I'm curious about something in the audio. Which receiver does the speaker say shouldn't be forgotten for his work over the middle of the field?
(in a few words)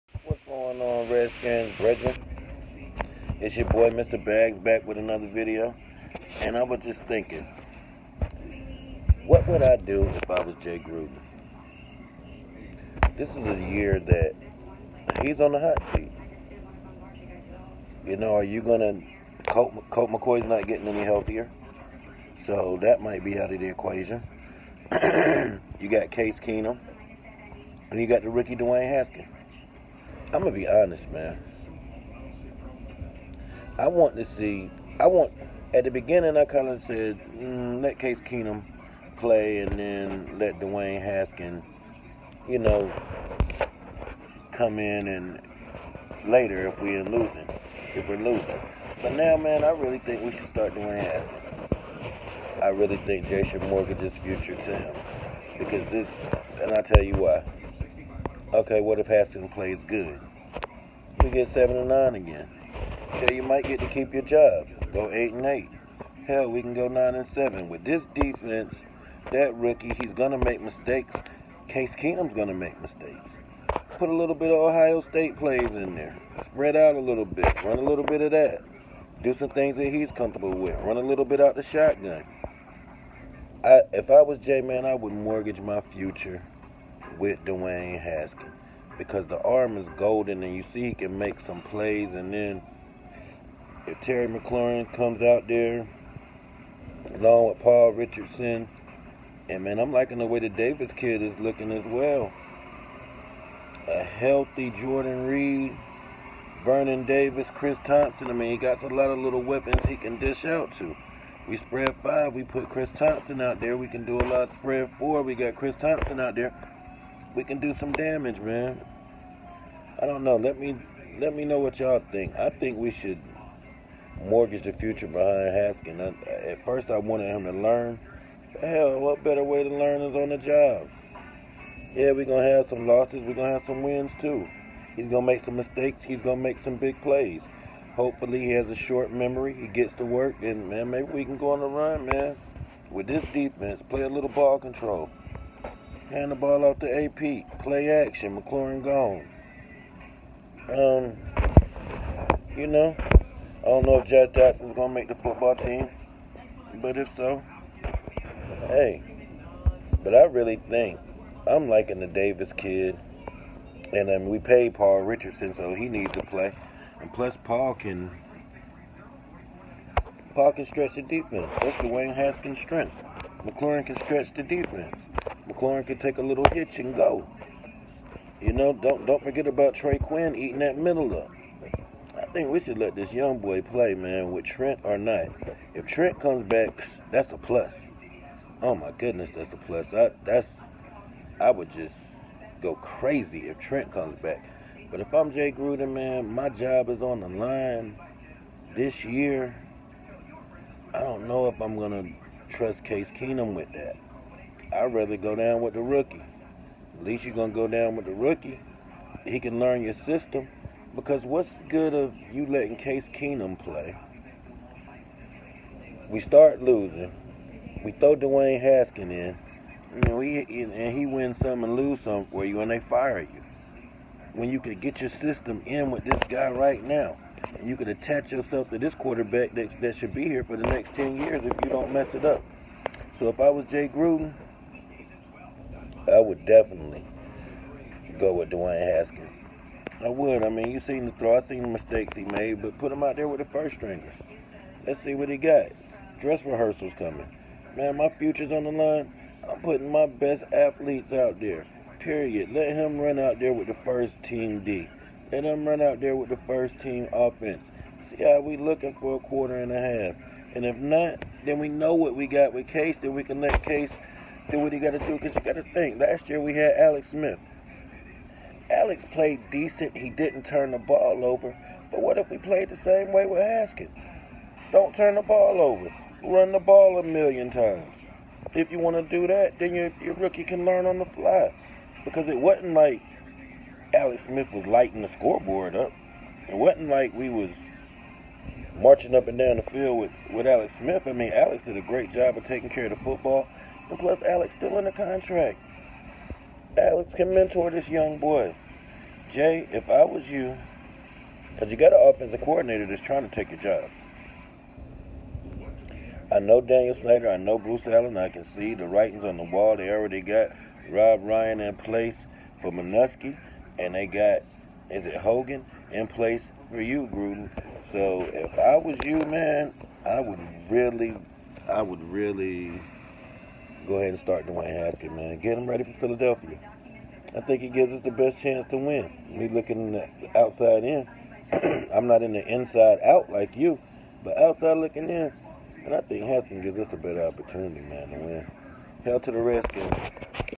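Trey Quinn.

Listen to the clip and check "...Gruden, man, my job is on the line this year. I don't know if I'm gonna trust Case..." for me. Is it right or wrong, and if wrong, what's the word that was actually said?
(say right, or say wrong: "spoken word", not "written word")
right.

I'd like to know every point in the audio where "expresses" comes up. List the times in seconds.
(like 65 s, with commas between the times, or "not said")
not said.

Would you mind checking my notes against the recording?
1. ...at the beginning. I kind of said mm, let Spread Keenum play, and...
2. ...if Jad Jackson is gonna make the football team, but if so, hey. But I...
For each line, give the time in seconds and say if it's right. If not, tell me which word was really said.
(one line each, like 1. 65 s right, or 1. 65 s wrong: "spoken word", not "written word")
1. 35 s wrong: "Case", not "Spread"
2. 153 s right.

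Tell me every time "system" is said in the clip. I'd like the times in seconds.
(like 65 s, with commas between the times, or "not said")
210 s, 225 s.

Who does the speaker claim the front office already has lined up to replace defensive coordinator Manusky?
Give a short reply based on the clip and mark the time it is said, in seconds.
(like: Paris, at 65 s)
Rob Ryan, at 310 s.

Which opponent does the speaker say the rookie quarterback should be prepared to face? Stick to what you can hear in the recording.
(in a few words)
Philadelphia.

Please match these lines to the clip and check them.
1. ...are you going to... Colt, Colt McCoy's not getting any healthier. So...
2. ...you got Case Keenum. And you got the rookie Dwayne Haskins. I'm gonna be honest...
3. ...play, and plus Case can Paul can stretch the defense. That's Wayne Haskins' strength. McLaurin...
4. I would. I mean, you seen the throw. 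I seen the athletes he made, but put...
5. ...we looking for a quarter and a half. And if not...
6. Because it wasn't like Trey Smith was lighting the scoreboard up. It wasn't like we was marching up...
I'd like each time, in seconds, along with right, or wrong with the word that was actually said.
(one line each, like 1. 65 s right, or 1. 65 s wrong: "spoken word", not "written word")
1. 18 s right
2. 25 s right
3. 166 s wrong: "Paul", not "Case"
4. 240 s wrong: "mistakes", not "athletes"
5. 258 s right
6. 282 s wrong: "Alex", not "Trey".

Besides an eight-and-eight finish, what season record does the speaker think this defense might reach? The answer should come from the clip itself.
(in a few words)
9 and 7.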